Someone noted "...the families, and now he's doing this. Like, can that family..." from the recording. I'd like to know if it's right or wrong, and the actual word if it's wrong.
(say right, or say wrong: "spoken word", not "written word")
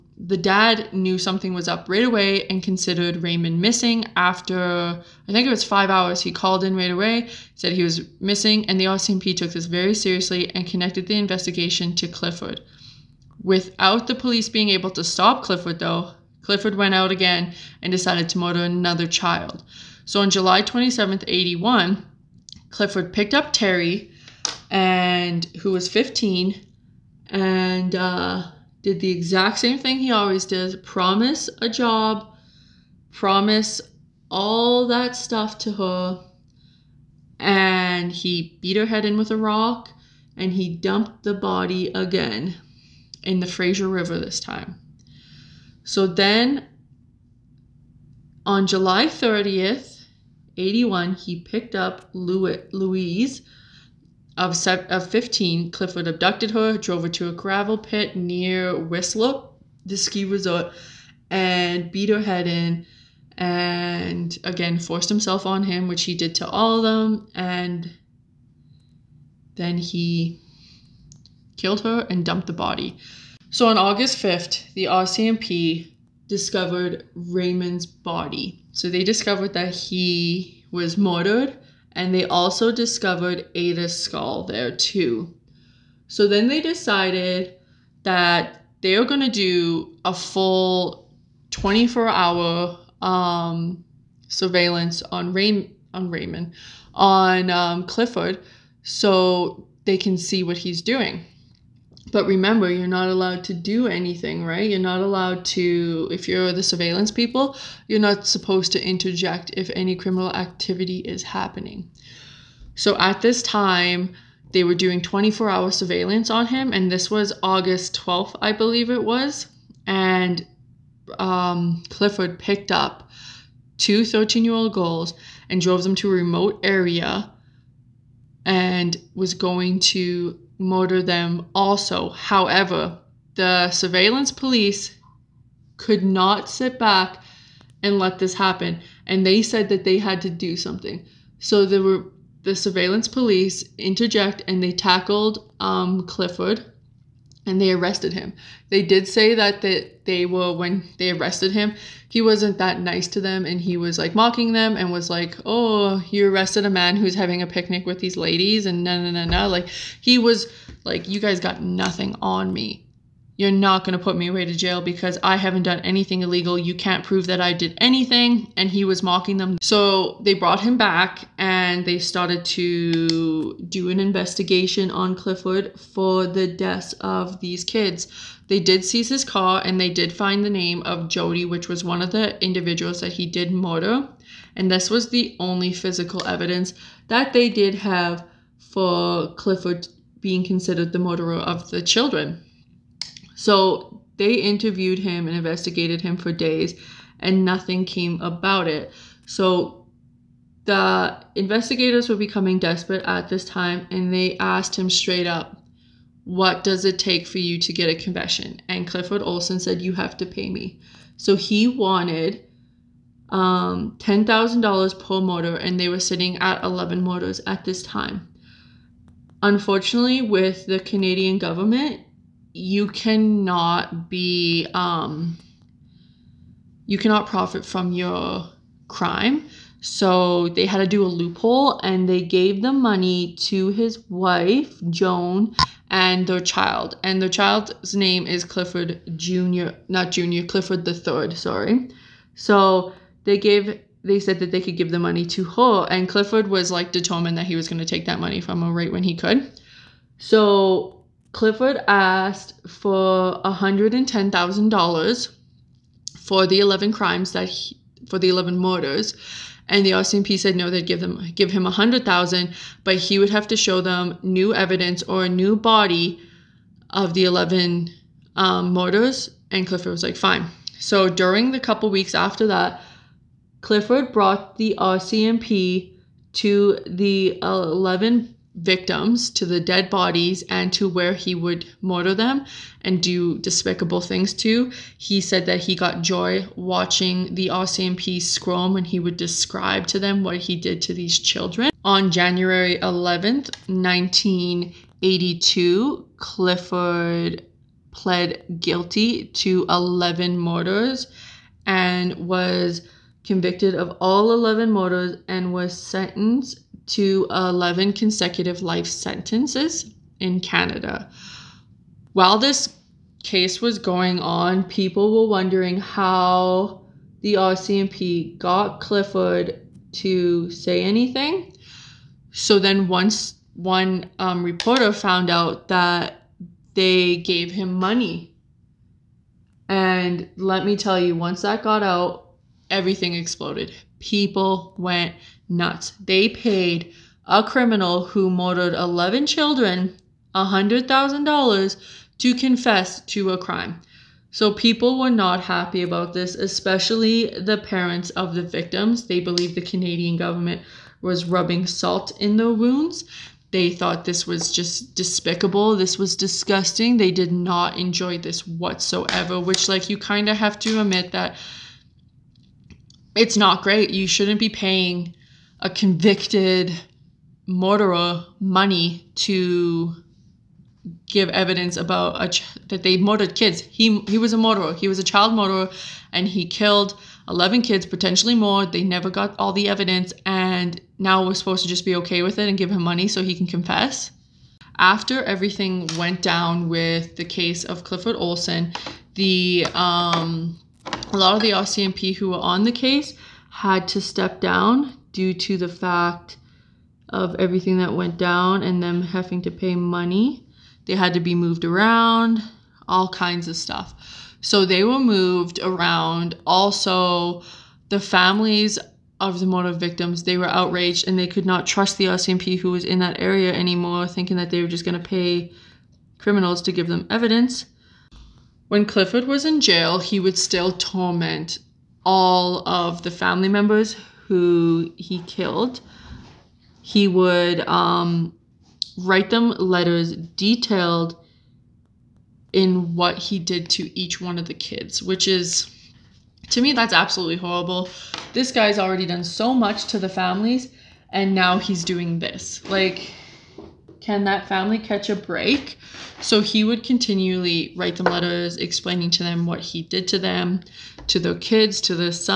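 right.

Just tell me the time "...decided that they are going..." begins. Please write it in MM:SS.
01:26.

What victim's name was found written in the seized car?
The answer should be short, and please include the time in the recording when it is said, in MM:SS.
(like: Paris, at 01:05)
Jody, at 03:01.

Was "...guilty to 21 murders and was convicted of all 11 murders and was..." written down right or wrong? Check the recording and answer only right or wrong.
wrong.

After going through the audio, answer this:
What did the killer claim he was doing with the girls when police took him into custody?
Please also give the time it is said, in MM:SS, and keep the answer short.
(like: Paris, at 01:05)
having a picnic, at 02:37.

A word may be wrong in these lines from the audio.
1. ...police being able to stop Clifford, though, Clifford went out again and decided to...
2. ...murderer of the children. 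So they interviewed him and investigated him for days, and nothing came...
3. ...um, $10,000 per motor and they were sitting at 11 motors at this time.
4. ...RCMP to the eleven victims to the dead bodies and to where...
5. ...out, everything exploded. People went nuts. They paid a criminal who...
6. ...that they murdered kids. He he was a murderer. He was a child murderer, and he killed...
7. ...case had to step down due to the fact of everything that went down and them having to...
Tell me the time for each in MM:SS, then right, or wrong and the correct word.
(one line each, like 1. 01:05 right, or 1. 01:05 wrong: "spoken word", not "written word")
1. 00:14 right
2. 03:11 right
3. 03:33 right
4. 04:34 right
5. 05:31 right
6. 06:12 right
7. 06:32 right.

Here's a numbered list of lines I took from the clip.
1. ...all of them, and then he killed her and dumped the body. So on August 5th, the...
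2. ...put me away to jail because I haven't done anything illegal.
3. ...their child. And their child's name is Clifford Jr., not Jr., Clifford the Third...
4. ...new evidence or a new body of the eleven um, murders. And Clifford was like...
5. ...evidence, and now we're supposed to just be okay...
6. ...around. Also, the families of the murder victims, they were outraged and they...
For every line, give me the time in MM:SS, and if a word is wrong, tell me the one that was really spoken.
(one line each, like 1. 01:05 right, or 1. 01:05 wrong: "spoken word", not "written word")
1. 01:06 right
2. 02:44 right
3. 03:56 right
4. 04:24 right
5. 06:19 right
6. 06:45 right.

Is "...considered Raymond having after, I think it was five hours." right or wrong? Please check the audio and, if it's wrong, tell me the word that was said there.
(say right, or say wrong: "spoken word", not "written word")
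wrong: "missing", not "having".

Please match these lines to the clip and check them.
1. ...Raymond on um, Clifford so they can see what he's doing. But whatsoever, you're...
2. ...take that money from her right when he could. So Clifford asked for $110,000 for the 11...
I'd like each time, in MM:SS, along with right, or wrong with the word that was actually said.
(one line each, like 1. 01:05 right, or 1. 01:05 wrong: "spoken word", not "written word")
1. 01:36 wrong: "remember", not "whatsoever"
2. 04:07 right.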